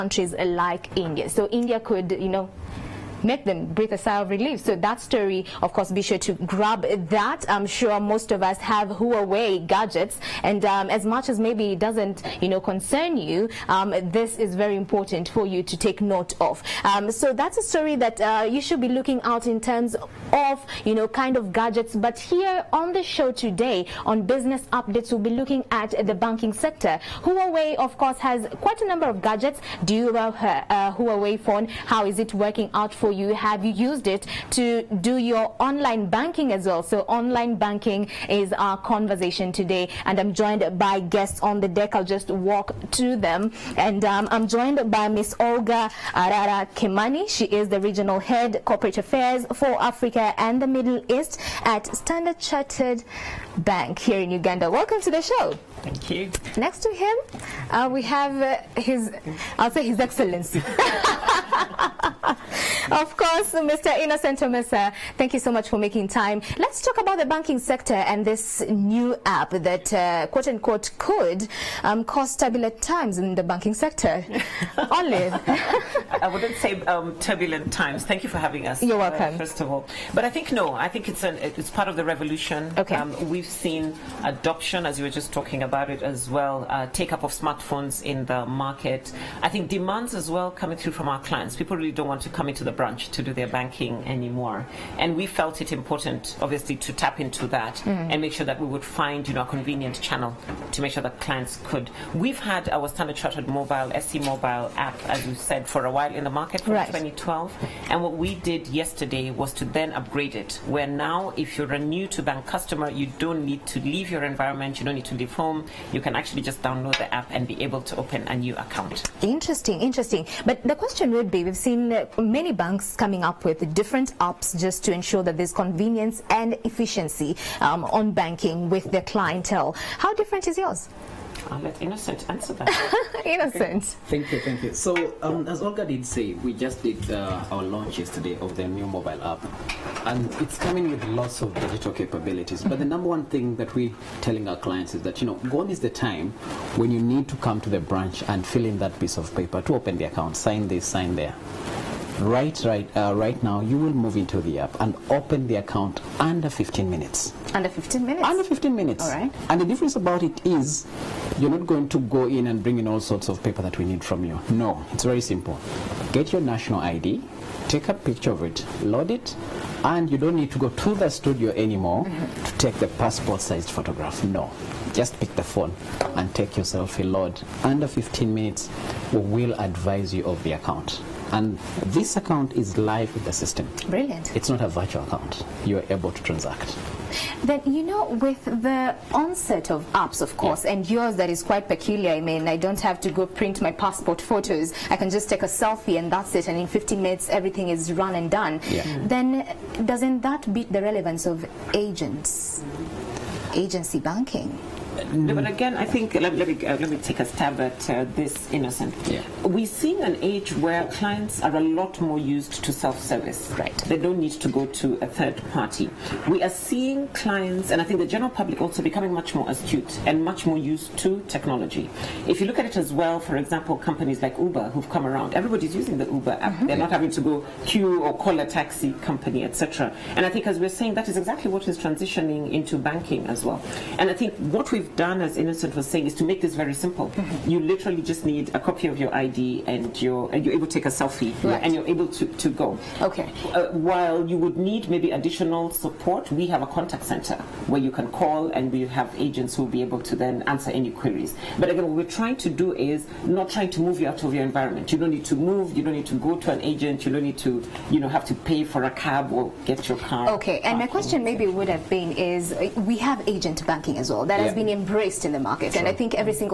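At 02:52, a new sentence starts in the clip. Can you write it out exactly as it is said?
to take the passport sized photograph no just pick the phone and take yourself a load.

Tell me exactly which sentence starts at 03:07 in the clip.
Then, you know, with the onset of apps, of course, yeah.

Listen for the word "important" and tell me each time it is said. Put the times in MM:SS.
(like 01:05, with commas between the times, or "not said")
00:14, 01:35.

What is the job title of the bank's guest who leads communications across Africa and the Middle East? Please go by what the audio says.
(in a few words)
Regional Head Corporate Affairs.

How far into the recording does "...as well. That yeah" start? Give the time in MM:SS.
04:23.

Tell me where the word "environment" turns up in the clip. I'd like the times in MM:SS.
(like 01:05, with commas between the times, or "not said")
01:54, 04:14.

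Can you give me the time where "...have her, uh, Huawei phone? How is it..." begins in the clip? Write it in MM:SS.
00:30.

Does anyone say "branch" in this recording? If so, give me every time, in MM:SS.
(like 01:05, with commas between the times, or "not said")
01:32, 02:27.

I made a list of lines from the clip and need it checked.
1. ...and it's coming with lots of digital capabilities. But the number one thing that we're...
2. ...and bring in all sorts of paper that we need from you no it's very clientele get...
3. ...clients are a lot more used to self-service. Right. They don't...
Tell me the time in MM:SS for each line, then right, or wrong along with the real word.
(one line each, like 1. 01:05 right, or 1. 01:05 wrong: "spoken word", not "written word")
1. 02:20 right
2. 02:42 wrong: "simple", not "clientele"
3. 03:30 right.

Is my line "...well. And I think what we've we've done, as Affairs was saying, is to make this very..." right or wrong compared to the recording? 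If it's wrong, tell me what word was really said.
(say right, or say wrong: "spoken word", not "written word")
wrong: "Innocent", not "Affairs".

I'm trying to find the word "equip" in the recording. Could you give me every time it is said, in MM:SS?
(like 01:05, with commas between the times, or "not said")
not said.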